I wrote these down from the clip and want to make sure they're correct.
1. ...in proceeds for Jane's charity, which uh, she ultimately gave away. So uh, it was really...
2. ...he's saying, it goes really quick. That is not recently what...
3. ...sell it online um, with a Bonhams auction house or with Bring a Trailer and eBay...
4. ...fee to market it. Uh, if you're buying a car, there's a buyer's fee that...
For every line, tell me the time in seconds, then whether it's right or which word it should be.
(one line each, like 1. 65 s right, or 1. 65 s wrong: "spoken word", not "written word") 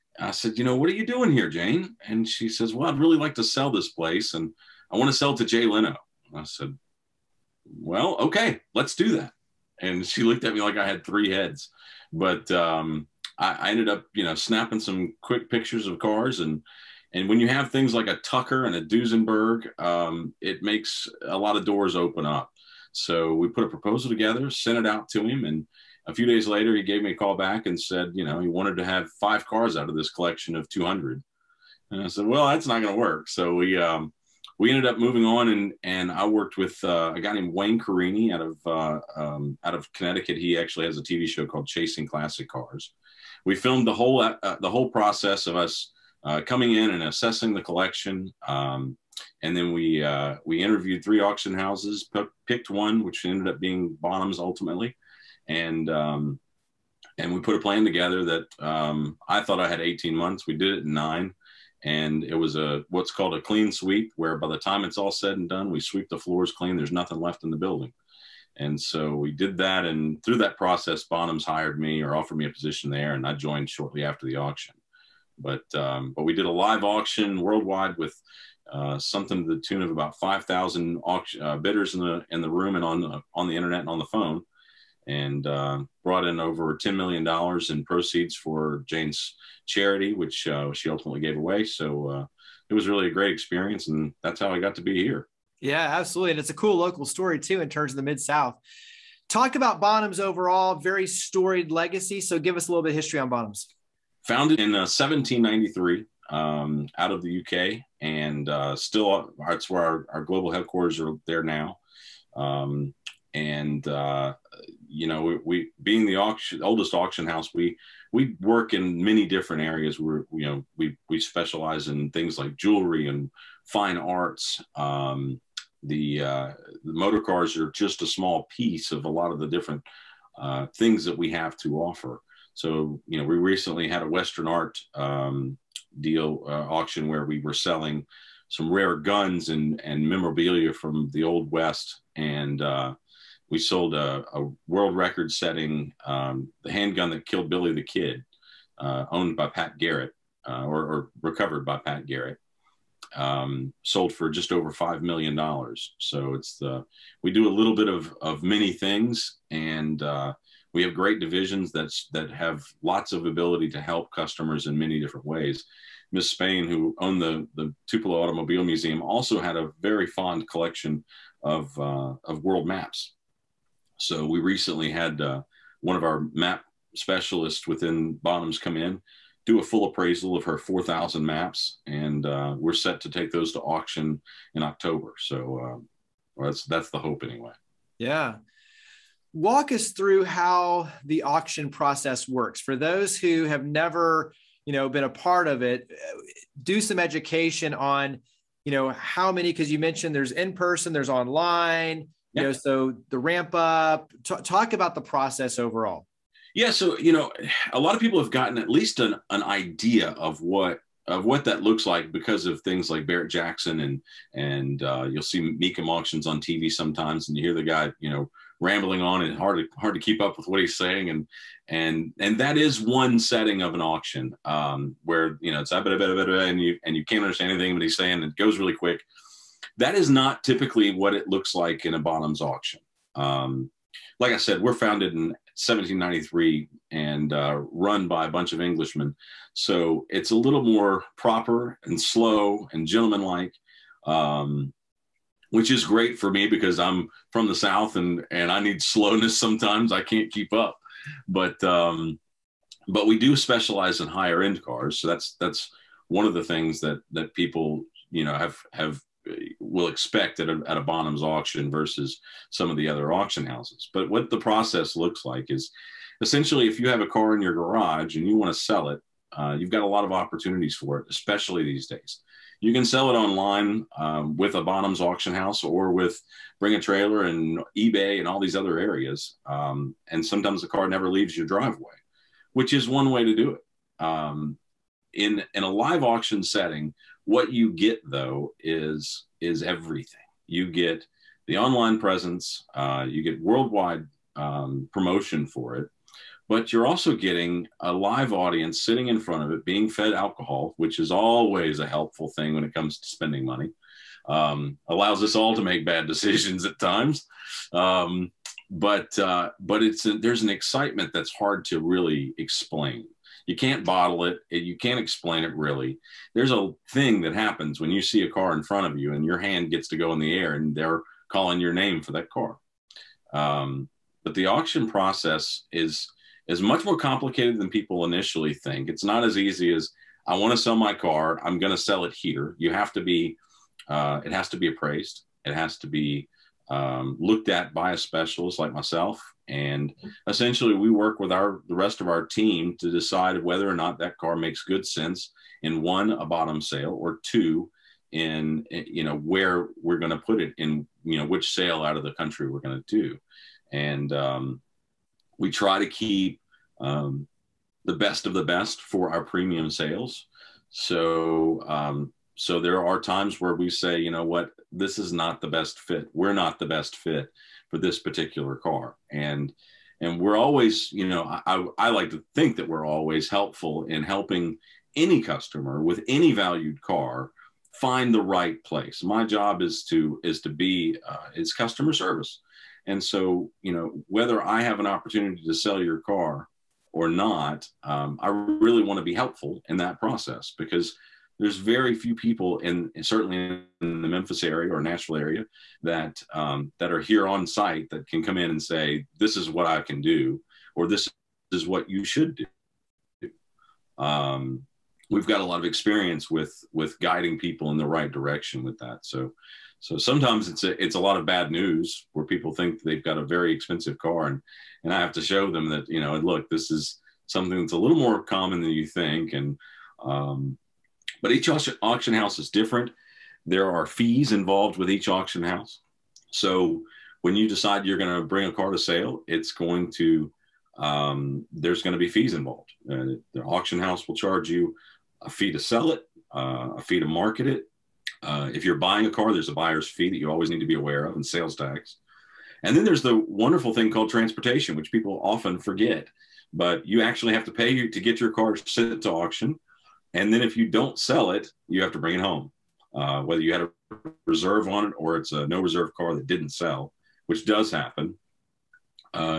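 1. 87 s right
2. 227 s wrong: "typically", not "recently"
3. 272 s right
4. 436 s right.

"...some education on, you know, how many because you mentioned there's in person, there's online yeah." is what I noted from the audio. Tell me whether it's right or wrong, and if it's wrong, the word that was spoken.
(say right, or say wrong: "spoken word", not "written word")
right.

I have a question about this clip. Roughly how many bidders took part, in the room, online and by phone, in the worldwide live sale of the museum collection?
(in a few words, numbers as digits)
5,000.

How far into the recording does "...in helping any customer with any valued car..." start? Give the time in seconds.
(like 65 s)
373 s.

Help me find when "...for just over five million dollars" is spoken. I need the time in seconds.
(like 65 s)
154 s.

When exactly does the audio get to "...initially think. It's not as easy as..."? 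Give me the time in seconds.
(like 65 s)
328 s.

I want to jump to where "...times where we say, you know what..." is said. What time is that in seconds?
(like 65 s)
362 s.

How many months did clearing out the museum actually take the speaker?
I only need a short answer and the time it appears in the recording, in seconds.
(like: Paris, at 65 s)
9, at 60 s.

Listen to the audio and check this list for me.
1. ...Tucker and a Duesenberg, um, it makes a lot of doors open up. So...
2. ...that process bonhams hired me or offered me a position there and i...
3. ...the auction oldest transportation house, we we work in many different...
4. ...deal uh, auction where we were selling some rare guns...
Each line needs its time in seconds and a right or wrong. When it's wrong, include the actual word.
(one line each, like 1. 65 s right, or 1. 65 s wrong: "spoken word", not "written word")
1. 18 s right
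2. 70 s right
3. 116 s wrong: "auction", not "transportation"
4. 136 s right.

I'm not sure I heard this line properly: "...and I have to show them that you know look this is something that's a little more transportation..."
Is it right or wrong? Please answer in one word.
wrong.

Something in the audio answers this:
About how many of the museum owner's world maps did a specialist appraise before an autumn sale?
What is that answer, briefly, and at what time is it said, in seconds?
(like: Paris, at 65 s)
4,000, at 180 s.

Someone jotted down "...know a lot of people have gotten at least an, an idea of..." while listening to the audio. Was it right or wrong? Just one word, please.
right.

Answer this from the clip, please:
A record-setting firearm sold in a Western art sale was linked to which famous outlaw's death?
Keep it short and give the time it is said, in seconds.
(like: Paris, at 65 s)
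Billy the Kid, at 147 s.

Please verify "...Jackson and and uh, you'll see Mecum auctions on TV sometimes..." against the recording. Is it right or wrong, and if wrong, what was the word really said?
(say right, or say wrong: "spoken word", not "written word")
right.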